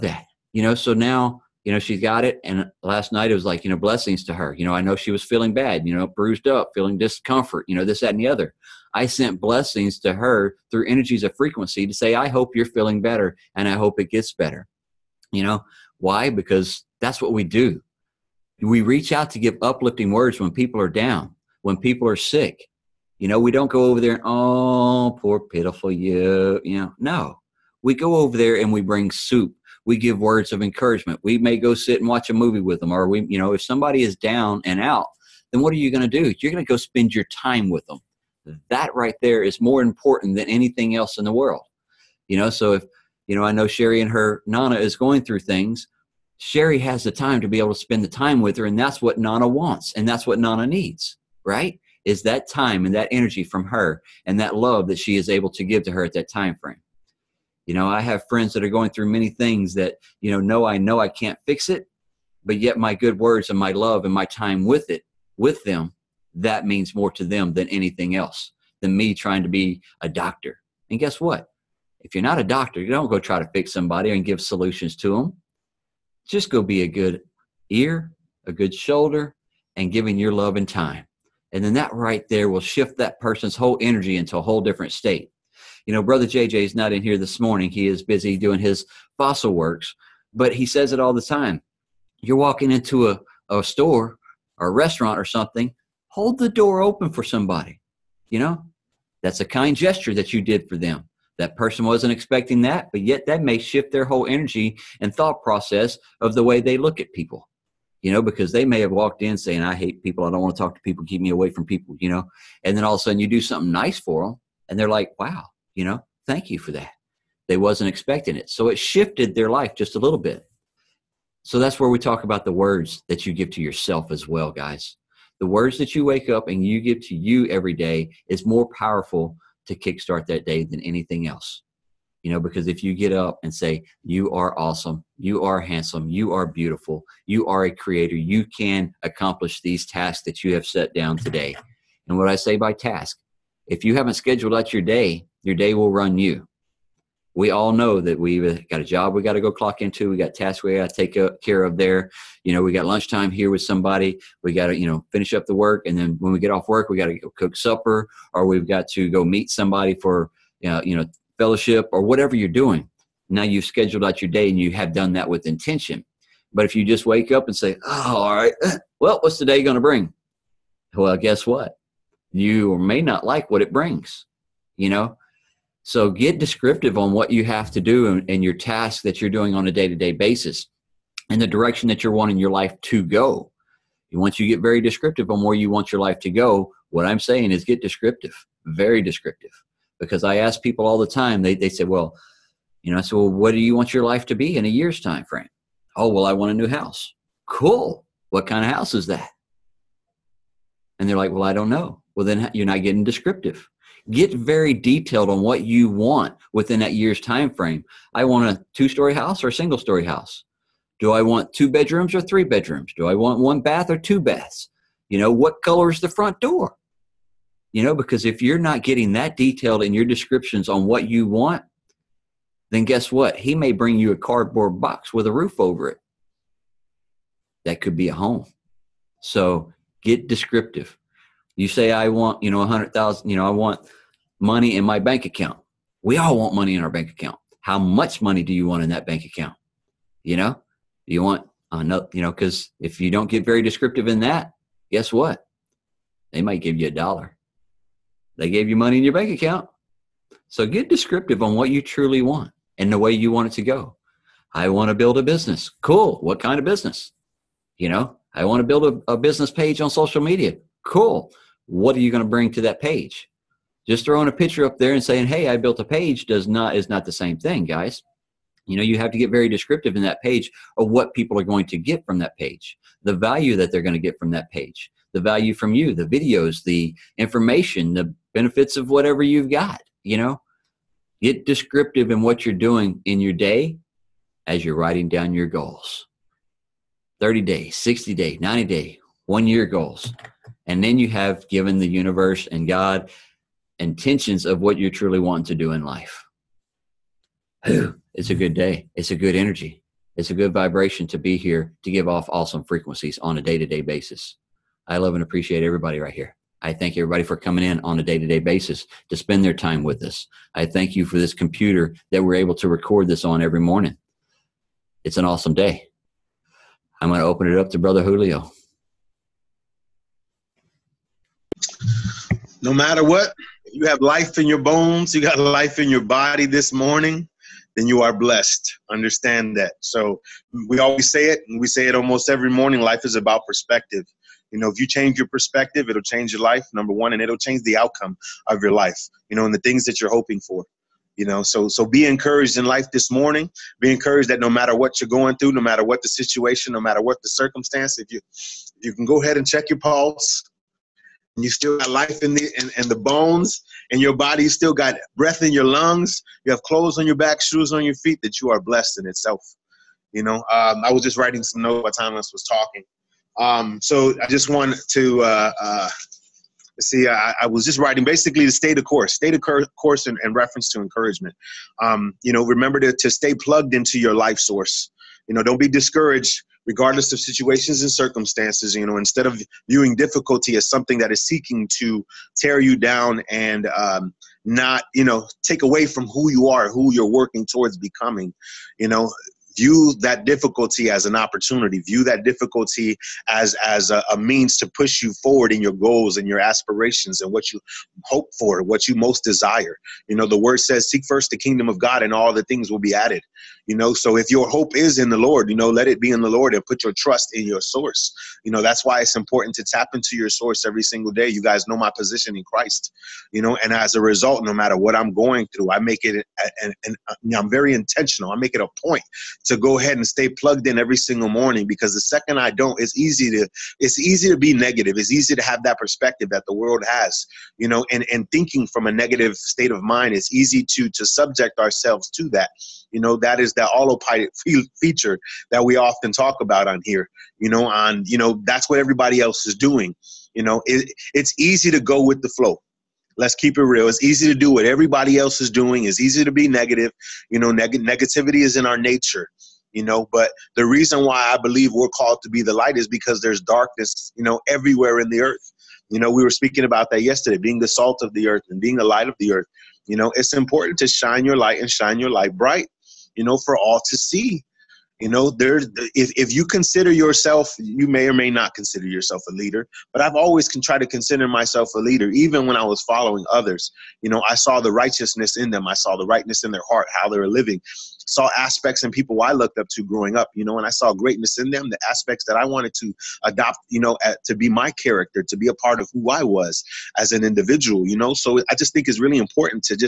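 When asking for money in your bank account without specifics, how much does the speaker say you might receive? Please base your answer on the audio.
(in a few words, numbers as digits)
a dollar.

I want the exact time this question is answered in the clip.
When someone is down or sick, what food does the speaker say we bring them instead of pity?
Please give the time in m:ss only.
0:29.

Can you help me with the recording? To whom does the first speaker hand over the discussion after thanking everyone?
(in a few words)
Brother Julio.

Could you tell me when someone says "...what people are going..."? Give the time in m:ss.
4:30.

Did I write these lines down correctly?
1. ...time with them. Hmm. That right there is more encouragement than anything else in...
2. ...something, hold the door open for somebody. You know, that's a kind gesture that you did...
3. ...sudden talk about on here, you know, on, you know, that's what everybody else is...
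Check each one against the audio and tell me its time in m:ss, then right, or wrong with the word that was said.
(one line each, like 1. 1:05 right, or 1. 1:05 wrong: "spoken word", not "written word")
1. 0:37 wrong: "important", not "encouragement"
2. 1:35 right
3. 7:15 wrong: "often", not "sudden".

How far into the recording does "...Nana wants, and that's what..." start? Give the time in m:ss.
0:49.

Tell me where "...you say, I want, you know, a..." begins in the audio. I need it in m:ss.
3:51.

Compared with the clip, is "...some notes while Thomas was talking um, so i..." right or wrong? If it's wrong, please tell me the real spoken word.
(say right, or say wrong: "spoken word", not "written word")
right.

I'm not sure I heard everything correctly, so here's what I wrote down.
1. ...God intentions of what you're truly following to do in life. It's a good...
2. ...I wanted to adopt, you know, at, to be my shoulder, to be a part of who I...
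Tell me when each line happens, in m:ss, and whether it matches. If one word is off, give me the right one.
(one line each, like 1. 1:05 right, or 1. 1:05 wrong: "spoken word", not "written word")
1. 4:52 wrong: "wanting", not "following"
2. 8:02 wrong: "character", not "shoulder".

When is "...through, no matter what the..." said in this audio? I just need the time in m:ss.
5:45.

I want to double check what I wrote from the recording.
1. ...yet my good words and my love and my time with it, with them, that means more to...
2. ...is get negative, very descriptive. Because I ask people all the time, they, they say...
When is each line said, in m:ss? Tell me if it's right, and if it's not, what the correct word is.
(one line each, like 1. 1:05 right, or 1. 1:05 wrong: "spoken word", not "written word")
1. 1:02 right
2. 3:07 wrong: "descriptive", not "negative".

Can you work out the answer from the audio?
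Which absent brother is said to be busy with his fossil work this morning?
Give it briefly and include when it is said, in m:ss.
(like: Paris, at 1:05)
Brother JJ, at 1:26.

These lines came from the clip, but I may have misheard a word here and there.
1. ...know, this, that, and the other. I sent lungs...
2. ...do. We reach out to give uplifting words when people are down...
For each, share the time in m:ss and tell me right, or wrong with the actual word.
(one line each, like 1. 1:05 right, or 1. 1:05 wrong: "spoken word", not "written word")
1. 0:07 wrong: "blessings", not "lungs"
2. 0:17 right.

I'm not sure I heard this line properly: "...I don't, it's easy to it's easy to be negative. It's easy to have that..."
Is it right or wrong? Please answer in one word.
right.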